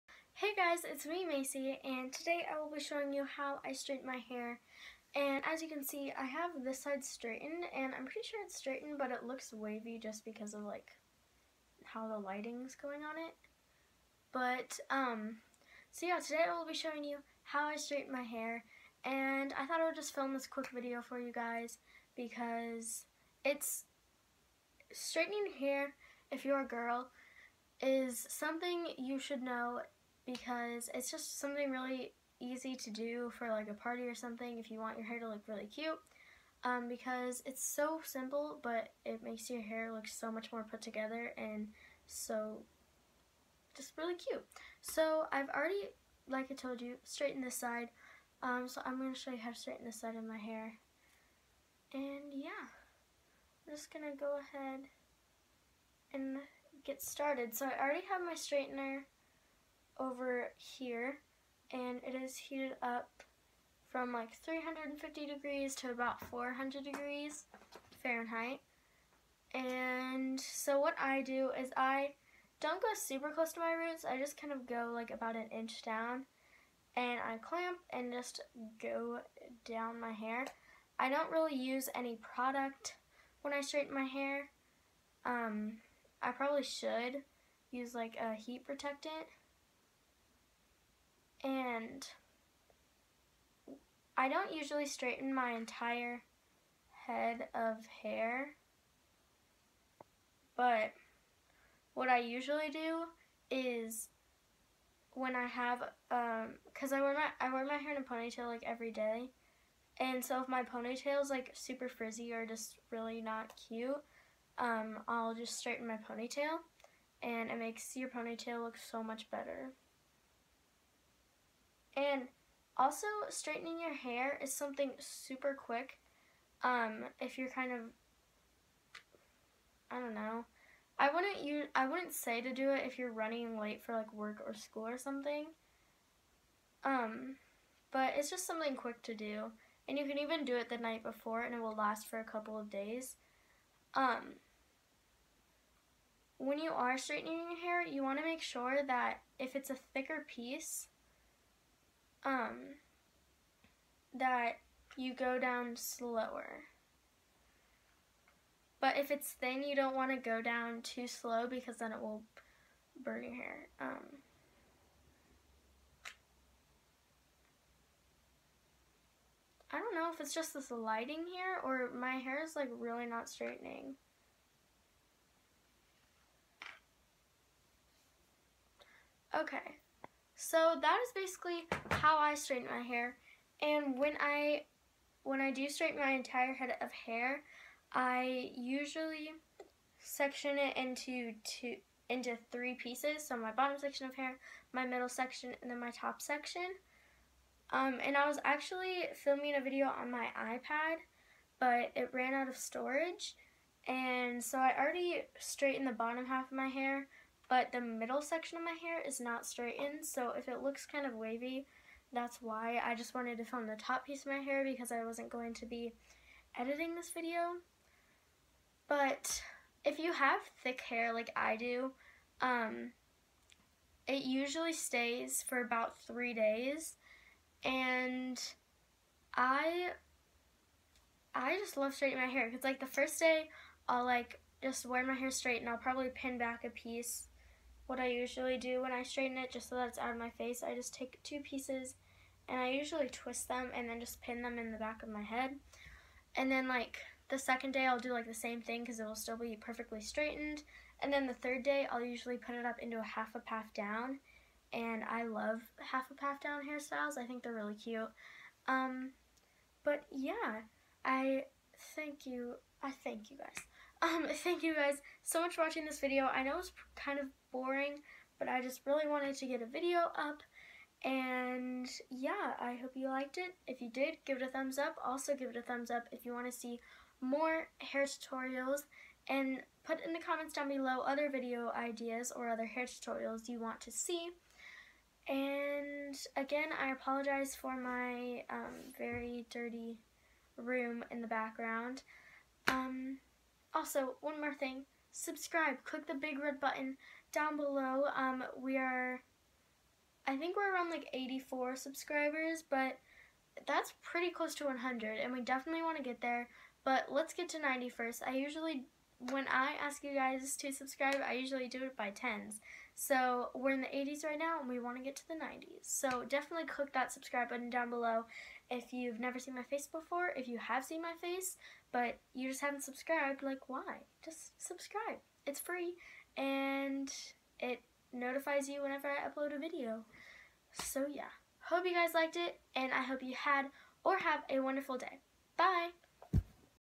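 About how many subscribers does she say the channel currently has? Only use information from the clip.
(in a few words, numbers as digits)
84.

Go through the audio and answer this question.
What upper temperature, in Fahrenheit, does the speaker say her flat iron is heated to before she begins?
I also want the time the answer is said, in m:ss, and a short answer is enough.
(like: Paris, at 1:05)
400 degrees, at 1:06.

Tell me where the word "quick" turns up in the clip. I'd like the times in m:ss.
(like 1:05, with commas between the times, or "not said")
0:20, 2:05, 2:18.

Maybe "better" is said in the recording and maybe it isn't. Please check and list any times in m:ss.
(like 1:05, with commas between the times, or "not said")
1:59.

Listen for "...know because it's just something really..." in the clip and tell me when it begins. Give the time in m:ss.
0:29.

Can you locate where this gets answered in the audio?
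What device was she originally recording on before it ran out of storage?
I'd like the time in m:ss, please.
3:20.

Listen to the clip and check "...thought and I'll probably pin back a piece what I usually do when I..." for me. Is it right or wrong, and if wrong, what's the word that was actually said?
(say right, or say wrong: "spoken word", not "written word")
wrong: "straight", not "thought".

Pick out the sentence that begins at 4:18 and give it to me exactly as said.
Um, but yeah, I thank you.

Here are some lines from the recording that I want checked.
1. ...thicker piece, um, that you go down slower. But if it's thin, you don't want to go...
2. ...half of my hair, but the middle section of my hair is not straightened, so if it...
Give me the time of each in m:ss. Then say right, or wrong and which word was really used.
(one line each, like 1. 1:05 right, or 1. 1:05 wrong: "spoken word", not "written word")
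1. 2:29 right
2. 3:26 right.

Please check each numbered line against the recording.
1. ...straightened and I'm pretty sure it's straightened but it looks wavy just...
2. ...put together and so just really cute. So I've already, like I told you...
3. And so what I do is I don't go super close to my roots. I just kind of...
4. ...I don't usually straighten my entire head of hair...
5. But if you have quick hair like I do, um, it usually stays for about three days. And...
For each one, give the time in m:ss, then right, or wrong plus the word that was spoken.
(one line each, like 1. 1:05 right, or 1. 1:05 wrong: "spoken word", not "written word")
1. 0:07 right
2. 0:40 right
3. 1:09 right
4. 1:34 right
5. 3:38 wrong: "thick", not "quick".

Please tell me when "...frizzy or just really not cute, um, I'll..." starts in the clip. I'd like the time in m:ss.
1:51.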